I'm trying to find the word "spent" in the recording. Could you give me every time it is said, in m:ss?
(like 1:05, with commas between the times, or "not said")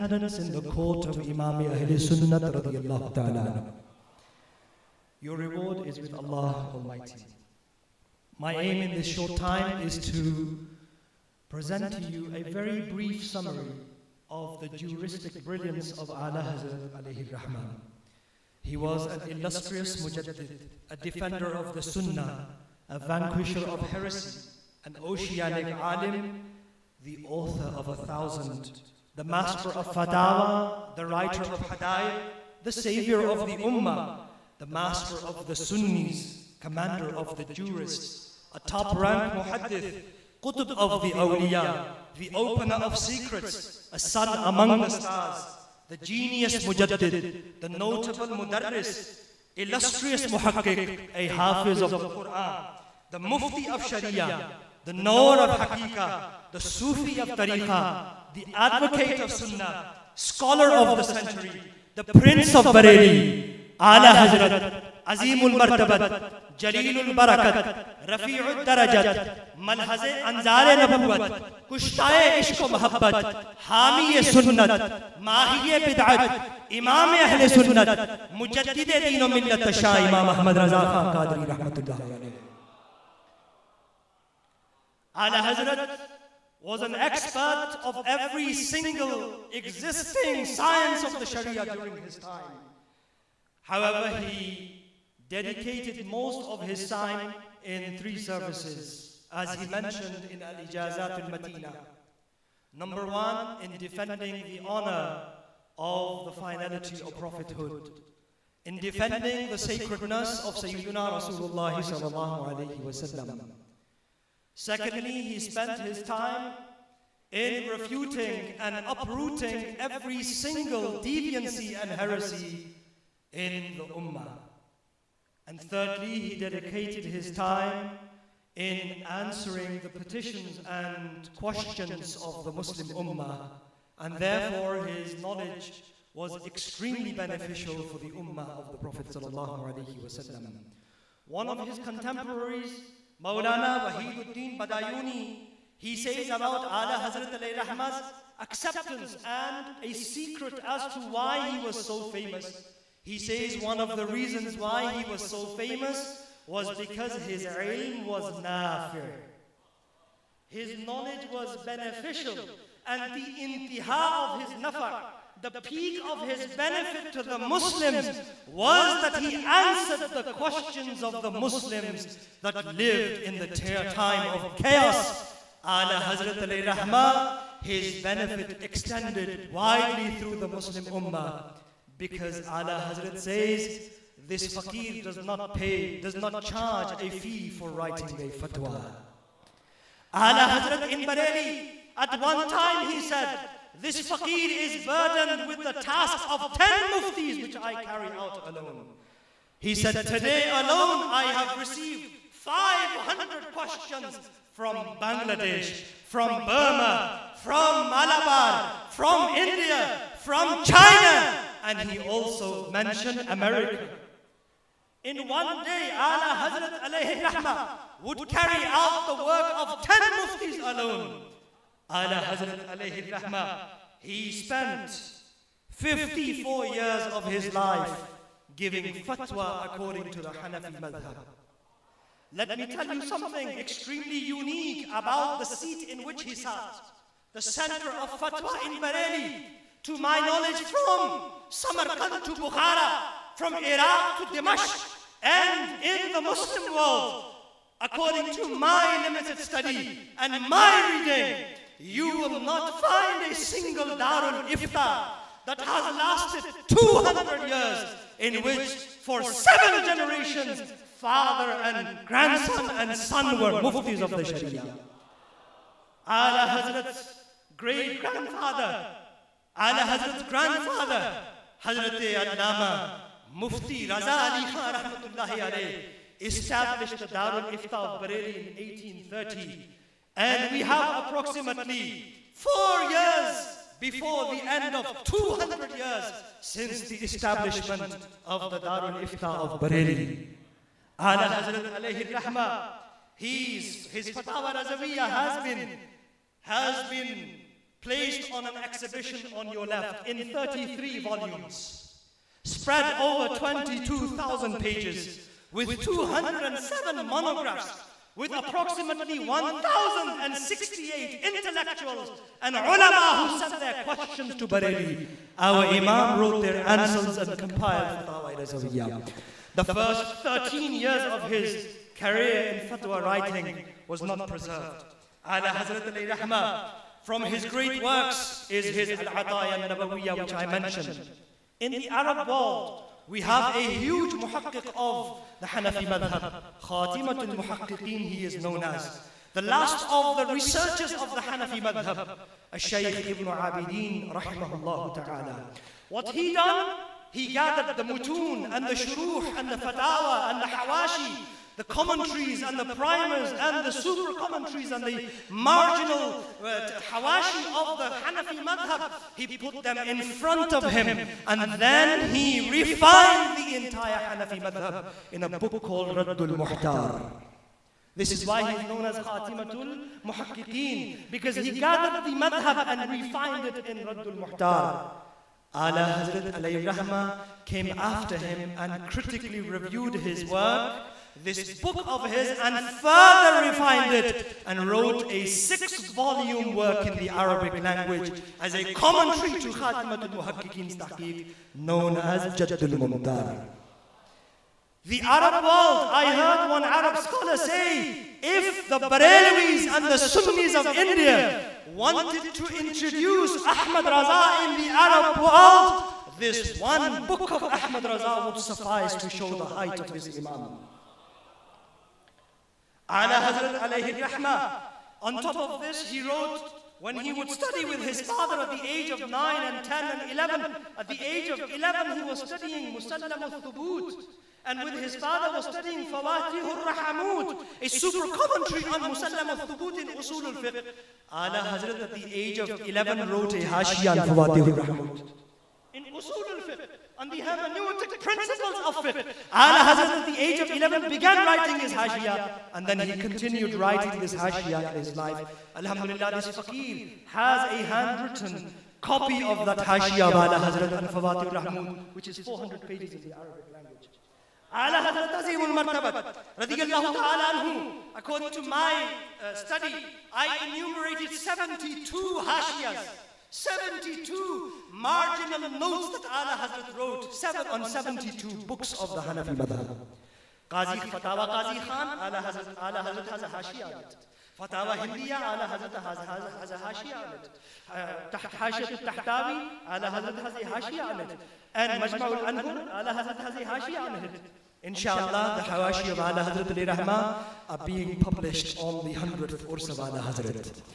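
1:55, 3:44.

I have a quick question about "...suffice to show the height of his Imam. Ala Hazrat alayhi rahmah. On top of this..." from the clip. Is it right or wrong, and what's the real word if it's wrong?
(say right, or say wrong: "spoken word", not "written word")
right.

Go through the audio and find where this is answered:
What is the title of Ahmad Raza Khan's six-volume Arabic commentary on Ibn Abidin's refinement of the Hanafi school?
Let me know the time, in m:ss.
6:32.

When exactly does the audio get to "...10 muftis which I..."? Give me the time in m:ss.
3:16.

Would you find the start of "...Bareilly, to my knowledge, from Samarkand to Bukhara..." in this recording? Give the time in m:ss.
3:58.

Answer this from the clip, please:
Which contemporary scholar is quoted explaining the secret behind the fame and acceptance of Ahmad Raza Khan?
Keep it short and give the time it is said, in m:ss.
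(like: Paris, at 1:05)
Maulana Wahiduddin Badayuni, at 2:23.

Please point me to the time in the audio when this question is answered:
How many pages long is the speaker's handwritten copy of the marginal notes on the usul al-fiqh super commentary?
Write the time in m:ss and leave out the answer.
7:32.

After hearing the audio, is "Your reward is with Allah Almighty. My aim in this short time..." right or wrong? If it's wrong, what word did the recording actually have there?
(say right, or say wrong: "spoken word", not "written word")
right.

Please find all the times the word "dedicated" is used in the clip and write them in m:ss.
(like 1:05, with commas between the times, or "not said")
1:35, 2:06.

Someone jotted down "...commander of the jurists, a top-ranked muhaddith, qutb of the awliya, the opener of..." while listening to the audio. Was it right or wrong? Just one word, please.
right.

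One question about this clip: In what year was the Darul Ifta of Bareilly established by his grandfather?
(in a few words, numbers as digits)
1830.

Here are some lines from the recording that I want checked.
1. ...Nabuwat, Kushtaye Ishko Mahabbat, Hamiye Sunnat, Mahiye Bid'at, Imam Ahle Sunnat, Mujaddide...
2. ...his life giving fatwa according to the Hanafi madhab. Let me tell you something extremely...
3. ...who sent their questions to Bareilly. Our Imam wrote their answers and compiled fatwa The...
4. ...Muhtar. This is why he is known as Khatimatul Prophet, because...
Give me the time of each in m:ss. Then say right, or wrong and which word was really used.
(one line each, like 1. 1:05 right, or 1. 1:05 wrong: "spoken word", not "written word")
1. 1:10 right
2. 3:47 right
3. 5:13 right
4. 6:06 wrong: "Muhakkikin", not "Prophet".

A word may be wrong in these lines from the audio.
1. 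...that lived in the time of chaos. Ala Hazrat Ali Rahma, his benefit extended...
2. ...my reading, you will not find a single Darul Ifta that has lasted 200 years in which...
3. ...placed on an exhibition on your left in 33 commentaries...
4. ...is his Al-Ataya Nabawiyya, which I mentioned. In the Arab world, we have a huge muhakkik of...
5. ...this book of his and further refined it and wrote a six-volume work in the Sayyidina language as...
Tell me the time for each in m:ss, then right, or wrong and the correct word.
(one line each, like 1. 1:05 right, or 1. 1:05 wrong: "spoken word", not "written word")
1. 2:52 right
2. 4:10 right
3. 4:57 wrong: "volumes", not "commentaries"
4. 5:28 right
5. 6:21 wrong: "Arabic", not "Sayyidina".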